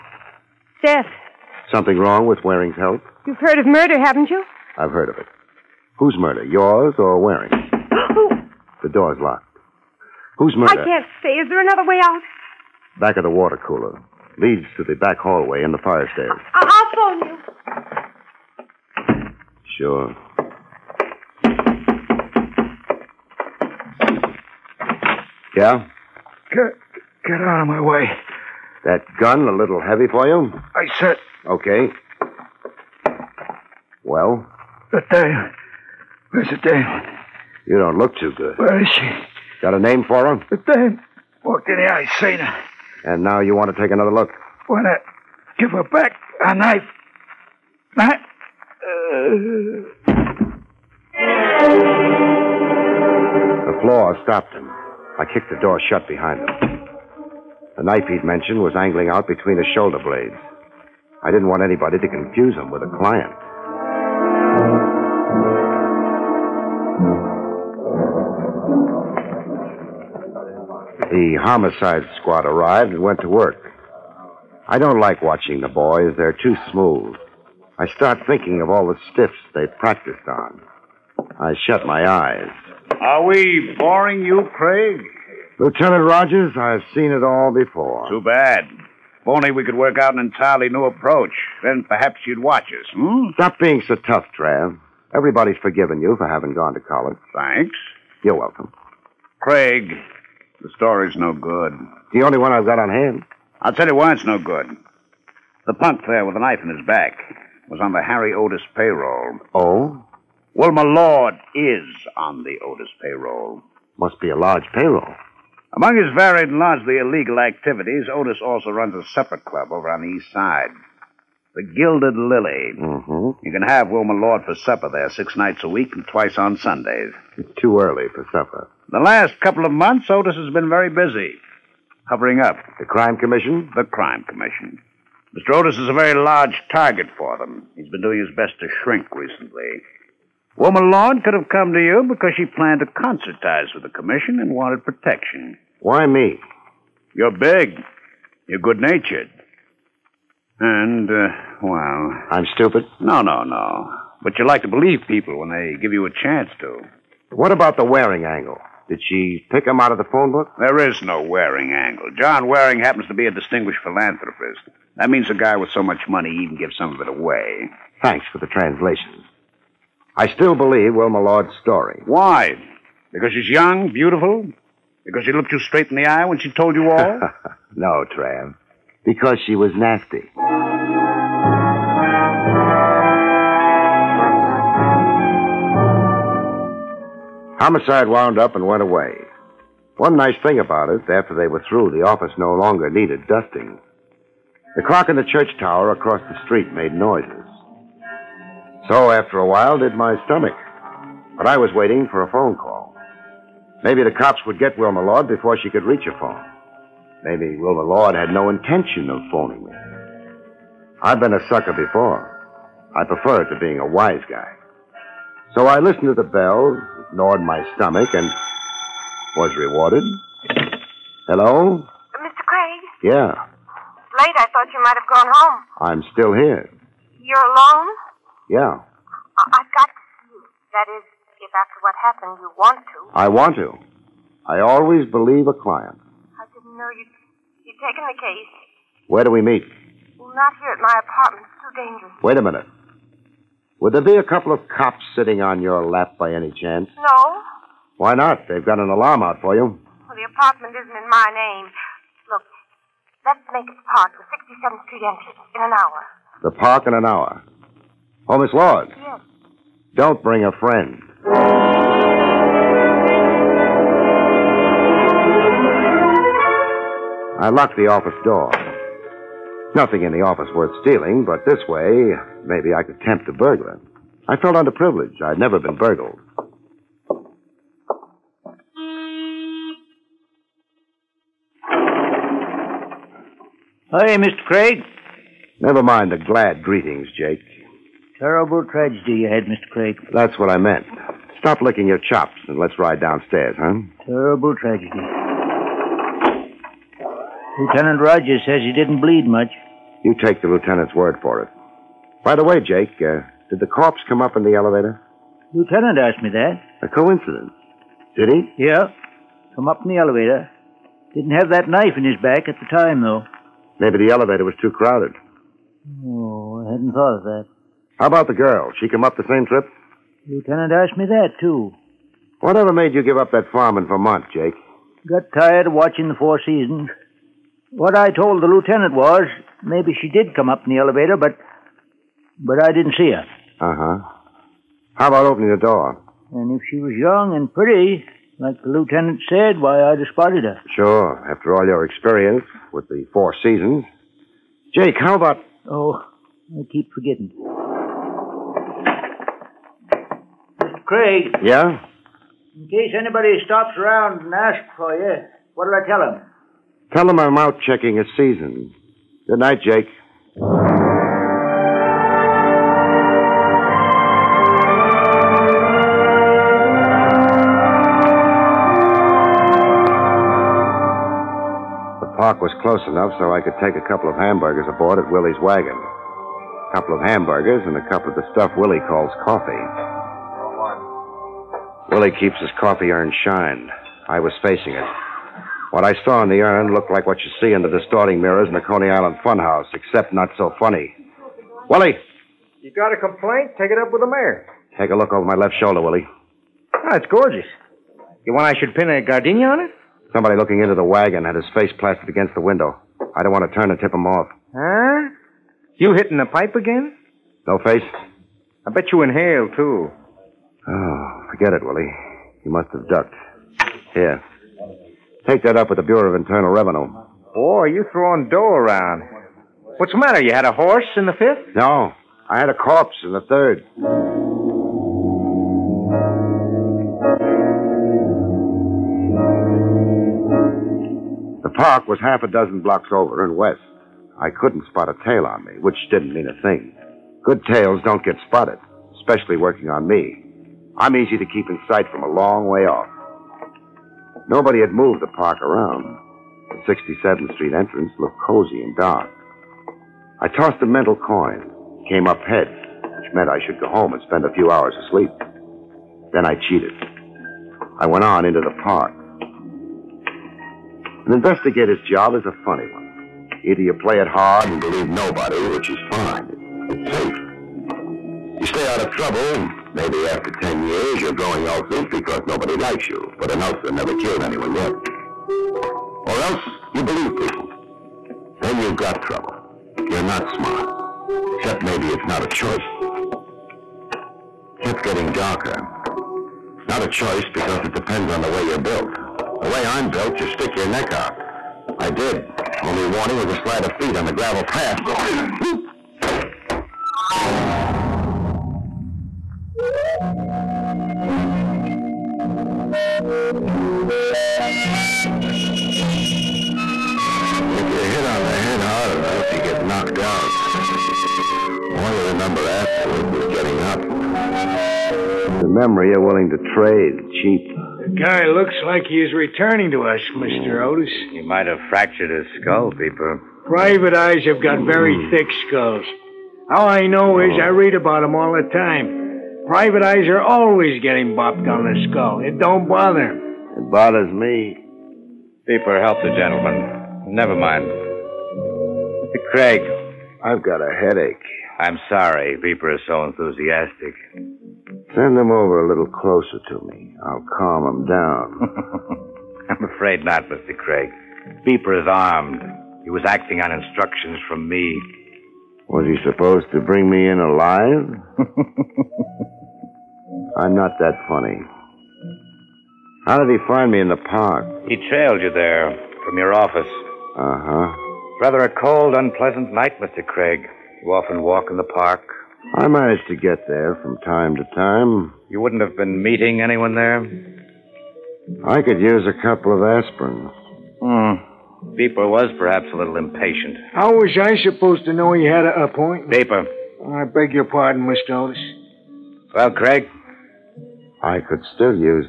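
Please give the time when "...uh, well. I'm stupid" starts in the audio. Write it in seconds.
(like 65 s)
151 s.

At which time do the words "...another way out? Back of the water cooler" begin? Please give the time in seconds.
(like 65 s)
11 s.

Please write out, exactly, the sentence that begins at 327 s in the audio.
What I told the lieutenant was maybe she did come up in the elevator, but but I didn't see her.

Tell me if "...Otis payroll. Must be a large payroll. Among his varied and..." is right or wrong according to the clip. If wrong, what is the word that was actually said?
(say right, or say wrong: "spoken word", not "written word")
right.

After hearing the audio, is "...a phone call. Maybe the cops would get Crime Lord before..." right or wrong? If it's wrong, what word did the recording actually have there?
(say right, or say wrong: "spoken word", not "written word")
wrong: "Wilma", not "Crime".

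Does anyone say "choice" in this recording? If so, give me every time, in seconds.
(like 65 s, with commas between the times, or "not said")
482 s, 487 s.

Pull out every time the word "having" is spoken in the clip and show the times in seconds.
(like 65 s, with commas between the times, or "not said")
96 s.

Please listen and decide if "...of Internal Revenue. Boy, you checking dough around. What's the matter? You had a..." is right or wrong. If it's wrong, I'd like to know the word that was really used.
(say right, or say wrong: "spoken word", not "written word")
wrong: "throwing", not "checking".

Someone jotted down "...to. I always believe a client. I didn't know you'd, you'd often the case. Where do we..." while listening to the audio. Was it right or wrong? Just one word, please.
wrong.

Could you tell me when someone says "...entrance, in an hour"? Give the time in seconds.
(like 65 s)
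255 s.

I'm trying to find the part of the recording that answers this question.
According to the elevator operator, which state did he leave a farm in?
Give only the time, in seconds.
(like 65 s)
323 s.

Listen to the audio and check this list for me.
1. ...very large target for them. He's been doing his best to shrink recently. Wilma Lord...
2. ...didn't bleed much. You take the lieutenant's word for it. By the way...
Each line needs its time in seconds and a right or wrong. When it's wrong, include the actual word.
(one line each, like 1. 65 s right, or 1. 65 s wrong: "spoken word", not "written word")
1. 135 s right
2. 298 s right.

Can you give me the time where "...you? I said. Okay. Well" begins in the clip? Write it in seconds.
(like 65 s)
30 s.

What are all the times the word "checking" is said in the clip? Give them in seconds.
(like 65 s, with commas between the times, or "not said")
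357 s.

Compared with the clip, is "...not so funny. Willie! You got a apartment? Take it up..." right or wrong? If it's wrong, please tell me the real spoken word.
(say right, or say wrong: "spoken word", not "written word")
wrong: "complaint", not "apartment".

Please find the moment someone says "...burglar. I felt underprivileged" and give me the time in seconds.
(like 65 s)
273 s.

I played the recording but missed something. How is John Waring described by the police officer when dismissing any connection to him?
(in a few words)
Distinguished philanthropist.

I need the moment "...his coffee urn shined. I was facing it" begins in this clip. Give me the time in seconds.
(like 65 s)
382 s.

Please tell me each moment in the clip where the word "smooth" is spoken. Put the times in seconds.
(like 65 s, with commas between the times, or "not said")
76 s.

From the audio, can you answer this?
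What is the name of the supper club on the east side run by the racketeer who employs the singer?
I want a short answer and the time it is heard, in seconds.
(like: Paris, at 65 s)
The Gilded Lily, at 121 s.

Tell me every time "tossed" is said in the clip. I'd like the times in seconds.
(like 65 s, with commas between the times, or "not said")
450 s.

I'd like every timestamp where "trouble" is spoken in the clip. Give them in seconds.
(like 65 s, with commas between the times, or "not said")
468 s, 479 s.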